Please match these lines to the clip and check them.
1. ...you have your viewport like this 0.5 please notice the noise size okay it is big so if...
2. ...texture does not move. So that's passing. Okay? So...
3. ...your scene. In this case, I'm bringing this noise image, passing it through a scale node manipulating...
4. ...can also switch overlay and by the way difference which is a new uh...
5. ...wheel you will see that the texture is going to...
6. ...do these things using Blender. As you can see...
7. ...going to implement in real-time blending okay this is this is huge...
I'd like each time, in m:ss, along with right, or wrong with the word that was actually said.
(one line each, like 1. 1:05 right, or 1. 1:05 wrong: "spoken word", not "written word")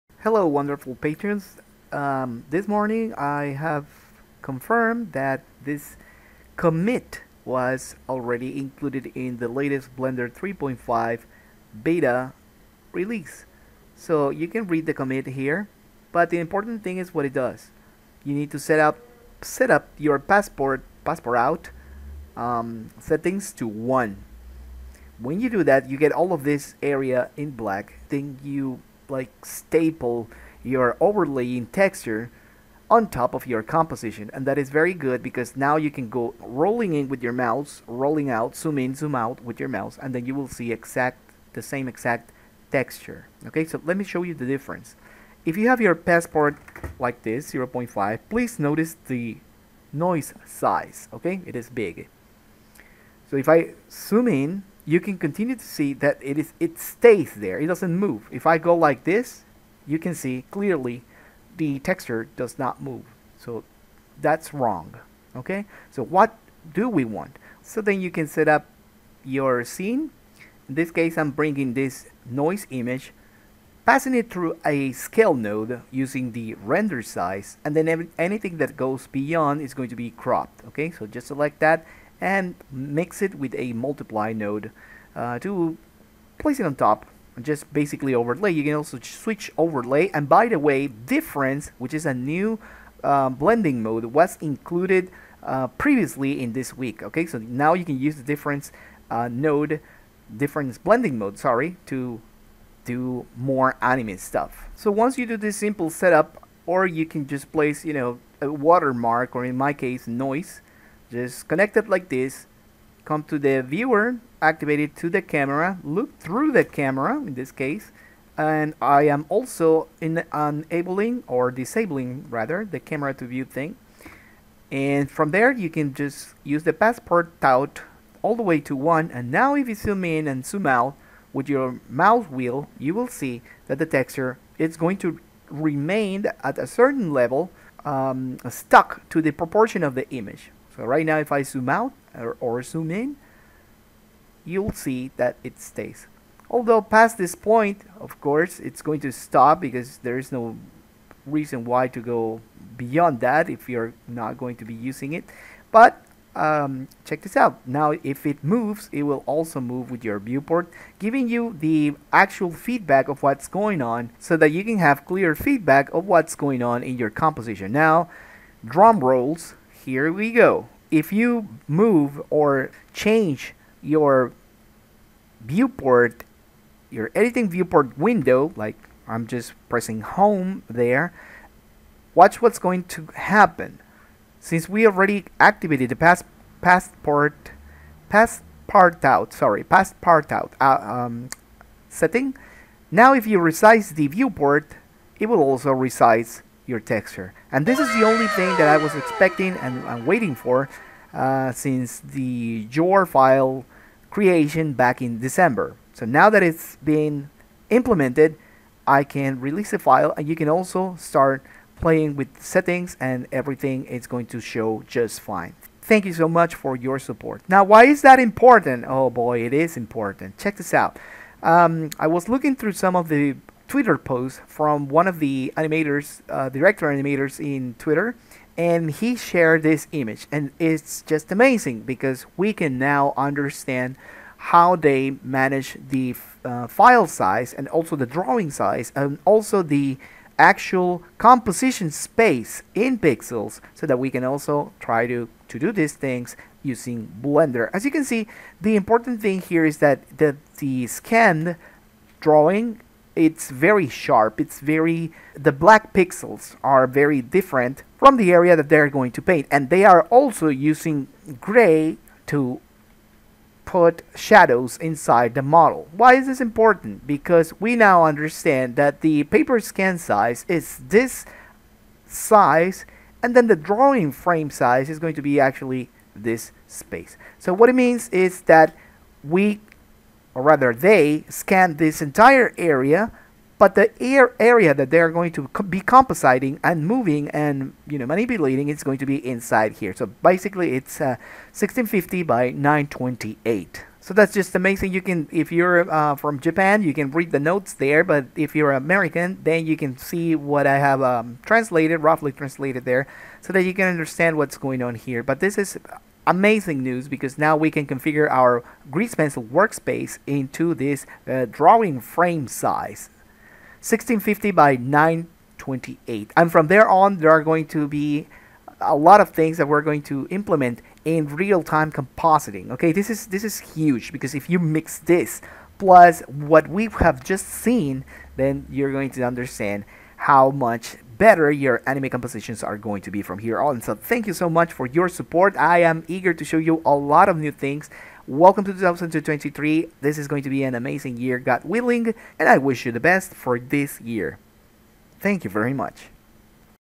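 1. 0:45 wrong: "passport", not "viewport"
2. 1:01 wrong: "wrong", not "passing"
3. 1:09 wrong: "using", not "manipulating"
4. 1:28 right
5. 2:12 right
6. 4:05 right
7. 5:19 wrong: "compositing", not "blending".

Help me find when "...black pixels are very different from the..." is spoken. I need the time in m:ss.
4:15.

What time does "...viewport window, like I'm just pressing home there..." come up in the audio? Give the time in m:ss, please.
2:57.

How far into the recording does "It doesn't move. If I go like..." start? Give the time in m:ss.
0:57.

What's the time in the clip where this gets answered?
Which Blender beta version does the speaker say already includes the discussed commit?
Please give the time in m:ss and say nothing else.
0:09.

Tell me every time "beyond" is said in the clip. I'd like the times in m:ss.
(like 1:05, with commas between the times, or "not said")
1:19, 2:32.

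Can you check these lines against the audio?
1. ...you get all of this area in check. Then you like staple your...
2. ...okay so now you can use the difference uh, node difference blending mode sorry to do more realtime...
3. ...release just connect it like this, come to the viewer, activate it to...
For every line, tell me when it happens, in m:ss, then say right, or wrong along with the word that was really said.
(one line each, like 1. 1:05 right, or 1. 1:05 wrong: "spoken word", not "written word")
1. 0:25 wrong: "black", not "check"
2. 1:37 wrong: "anime", not "realtime"
3. 1:50 wrong: "noise", not "release".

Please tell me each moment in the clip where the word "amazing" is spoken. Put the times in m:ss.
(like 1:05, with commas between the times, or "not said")
3:51, 4:54, 5:06, 5:40.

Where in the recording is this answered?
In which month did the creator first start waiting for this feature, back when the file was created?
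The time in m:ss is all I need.
3:25.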